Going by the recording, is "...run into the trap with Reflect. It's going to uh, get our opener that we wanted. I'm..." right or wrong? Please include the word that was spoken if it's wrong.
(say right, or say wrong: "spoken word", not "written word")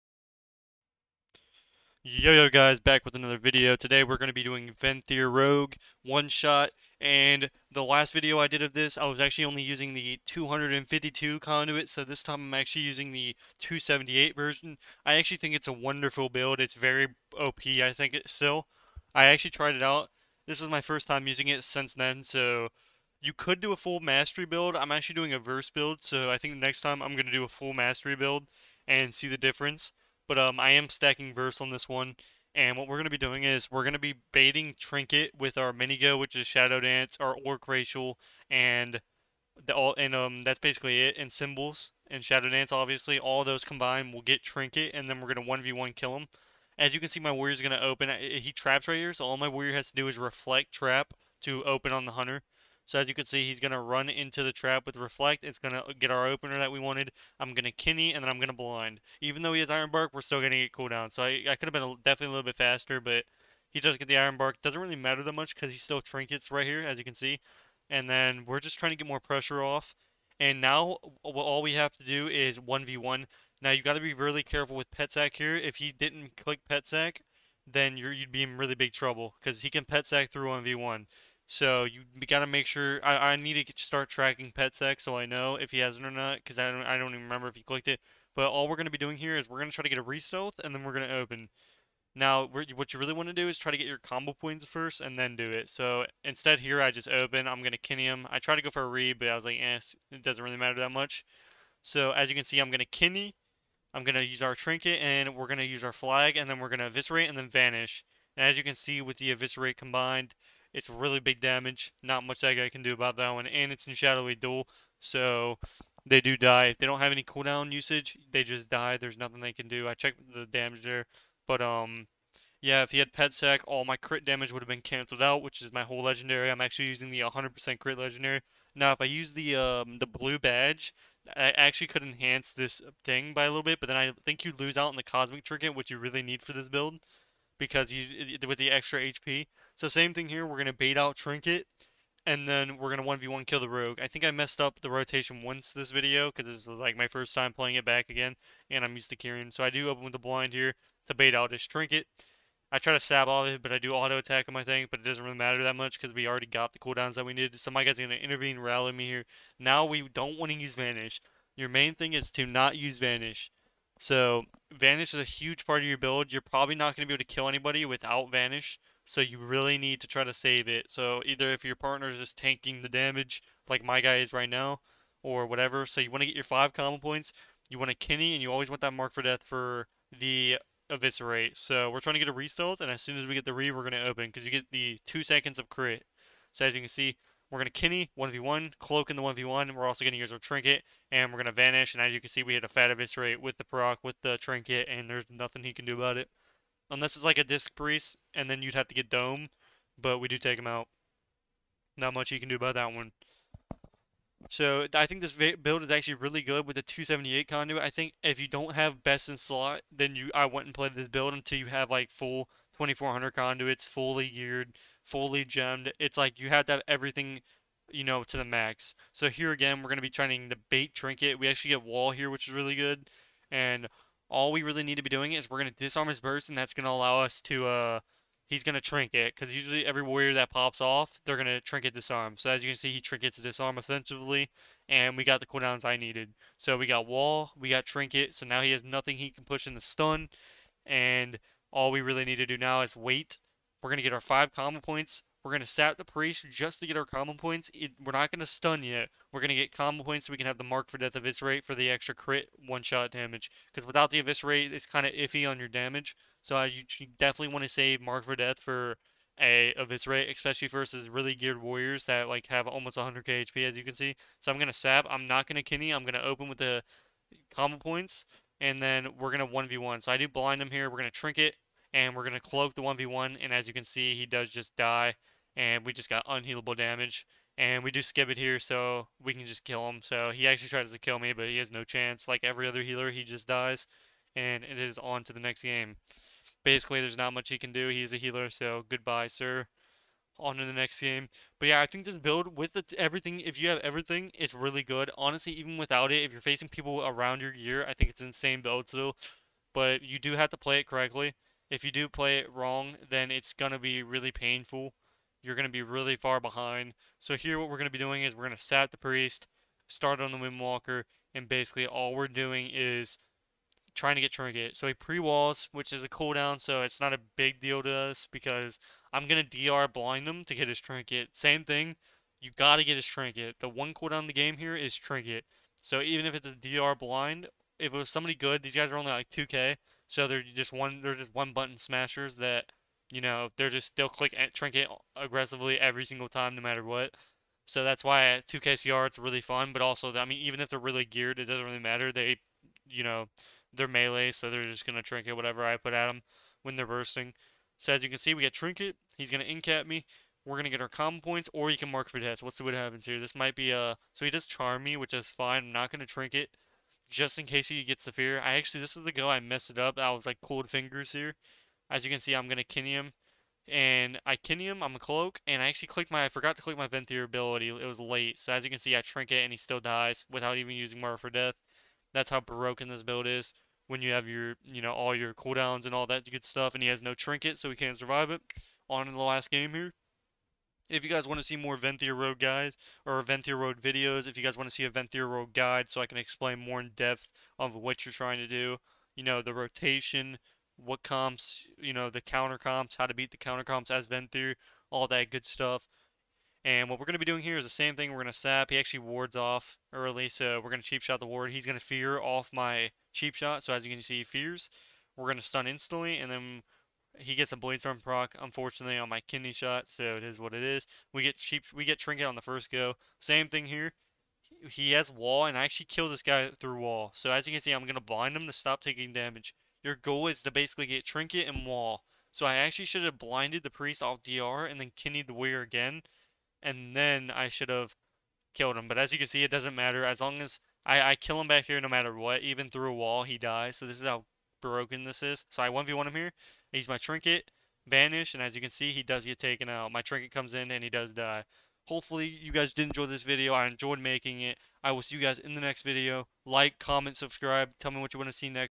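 right.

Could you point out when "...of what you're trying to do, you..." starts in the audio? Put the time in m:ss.
6:27.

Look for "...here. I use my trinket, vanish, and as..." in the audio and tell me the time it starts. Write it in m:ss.
7:16.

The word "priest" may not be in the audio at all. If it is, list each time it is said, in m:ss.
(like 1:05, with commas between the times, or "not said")
3:17, 4:06, 5:08, 7:03.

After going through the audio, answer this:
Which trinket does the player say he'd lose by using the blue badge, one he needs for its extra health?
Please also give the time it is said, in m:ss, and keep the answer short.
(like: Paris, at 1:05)
Cosmic Trinket, at 2:15.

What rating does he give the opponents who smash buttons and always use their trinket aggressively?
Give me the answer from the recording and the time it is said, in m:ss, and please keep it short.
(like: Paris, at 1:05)
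2k, at 5:29.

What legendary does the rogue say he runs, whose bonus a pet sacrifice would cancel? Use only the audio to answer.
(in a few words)
100% crit legendary.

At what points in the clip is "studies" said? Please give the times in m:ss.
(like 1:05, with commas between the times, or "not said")
not said.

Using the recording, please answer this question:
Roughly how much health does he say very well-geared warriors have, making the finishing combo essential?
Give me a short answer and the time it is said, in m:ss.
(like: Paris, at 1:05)
100k, at 4:22.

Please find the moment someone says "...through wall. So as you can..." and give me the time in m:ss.
6:56.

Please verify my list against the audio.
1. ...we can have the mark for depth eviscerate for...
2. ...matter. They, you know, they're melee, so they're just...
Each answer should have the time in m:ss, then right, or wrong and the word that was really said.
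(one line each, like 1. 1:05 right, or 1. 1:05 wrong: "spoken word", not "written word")
1. 4:10 wrong: "death", not "depth"
2. 5:41 right.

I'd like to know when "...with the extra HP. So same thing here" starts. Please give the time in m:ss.
2:18.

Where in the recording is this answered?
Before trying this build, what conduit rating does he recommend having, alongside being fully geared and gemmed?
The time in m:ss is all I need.
3:32.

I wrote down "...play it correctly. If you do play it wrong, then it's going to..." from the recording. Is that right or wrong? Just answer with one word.
right.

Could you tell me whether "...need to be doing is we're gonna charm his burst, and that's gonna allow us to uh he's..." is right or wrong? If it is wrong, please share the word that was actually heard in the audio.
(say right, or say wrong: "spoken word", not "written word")
wrong: "disarm", not "charm".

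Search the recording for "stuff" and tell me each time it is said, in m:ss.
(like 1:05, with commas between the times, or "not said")
6:16, 6:35.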